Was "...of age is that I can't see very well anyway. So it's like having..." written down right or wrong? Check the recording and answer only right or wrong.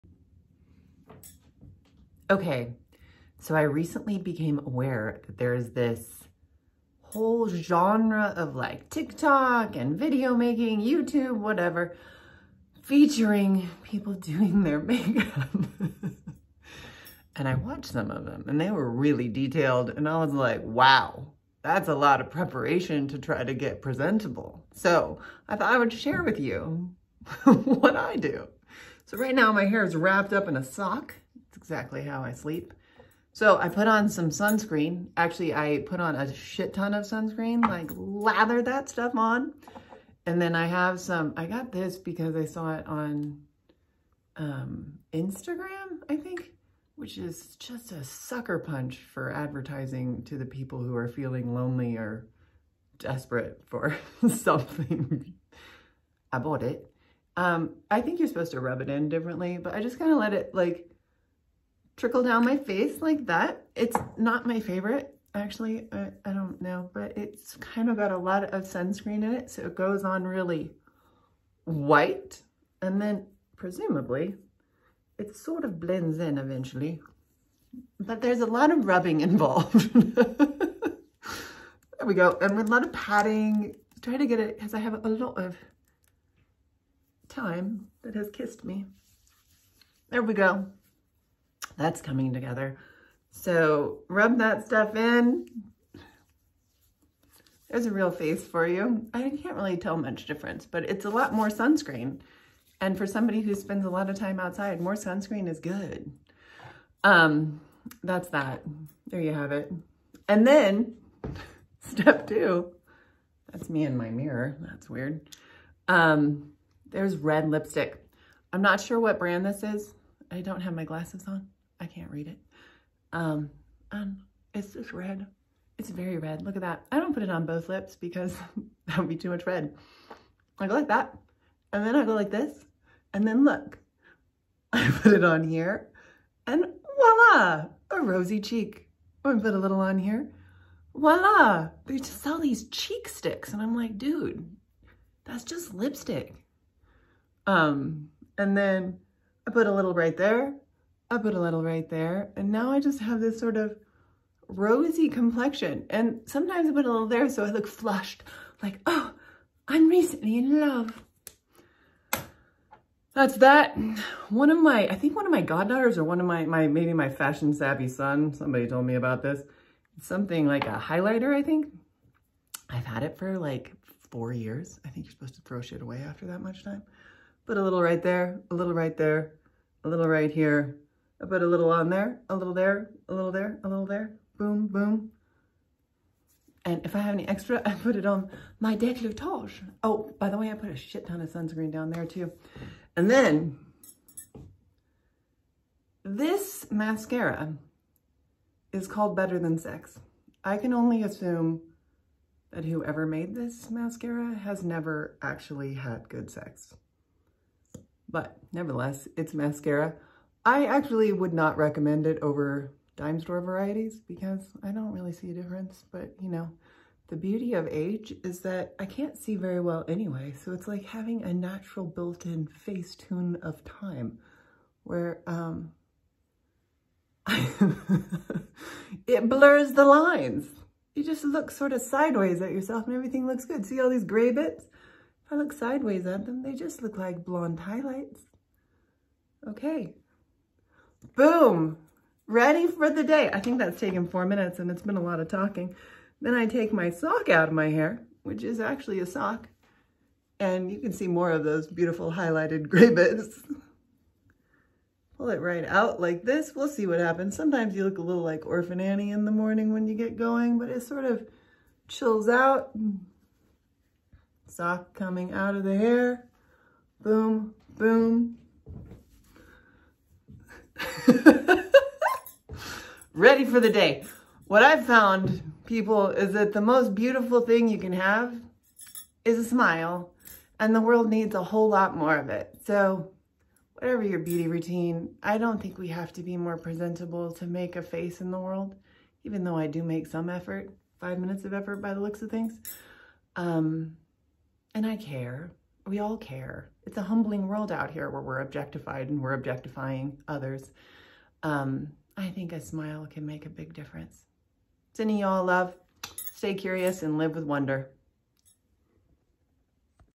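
right.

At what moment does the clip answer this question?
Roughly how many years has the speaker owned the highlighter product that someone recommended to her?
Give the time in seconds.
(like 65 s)
174 s.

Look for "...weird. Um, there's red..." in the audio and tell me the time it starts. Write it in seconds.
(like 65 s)
114 s.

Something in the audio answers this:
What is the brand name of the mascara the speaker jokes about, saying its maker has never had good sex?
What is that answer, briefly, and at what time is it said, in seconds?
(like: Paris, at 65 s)
Better Than Sex, at 199 s.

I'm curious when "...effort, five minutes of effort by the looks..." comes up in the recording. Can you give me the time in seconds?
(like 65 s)
290 s.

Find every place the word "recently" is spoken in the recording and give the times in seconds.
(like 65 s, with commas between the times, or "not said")
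3 s, 159 s.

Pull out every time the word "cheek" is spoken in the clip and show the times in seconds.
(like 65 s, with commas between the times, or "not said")
138 s, 142 s.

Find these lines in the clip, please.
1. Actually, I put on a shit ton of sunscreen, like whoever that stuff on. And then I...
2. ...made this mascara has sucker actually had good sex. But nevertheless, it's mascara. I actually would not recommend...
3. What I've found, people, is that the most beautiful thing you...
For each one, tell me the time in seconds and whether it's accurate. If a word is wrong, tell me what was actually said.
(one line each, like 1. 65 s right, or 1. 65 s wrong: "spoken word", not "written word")
1. 35 s wrong: "lather", not "whoever"
2. 203 s wrong: "never", not "sucker"
3. 274 s right.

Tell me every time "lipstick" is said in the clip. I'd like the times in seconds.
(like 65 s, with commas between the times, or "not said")
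117 s, 145 s.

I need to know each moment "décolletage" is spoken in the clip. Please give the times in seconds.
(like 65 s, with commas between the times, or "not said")
188 s.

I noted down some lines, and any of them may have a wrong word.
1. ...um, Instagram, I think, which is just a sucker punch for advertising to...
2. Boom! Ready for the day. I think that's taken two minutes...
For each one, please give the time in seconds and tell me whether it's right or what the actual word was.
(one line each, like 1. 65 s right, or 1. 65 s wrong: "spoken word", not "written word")
1. 44 s right
2. 241 s wrong: "four", not "two".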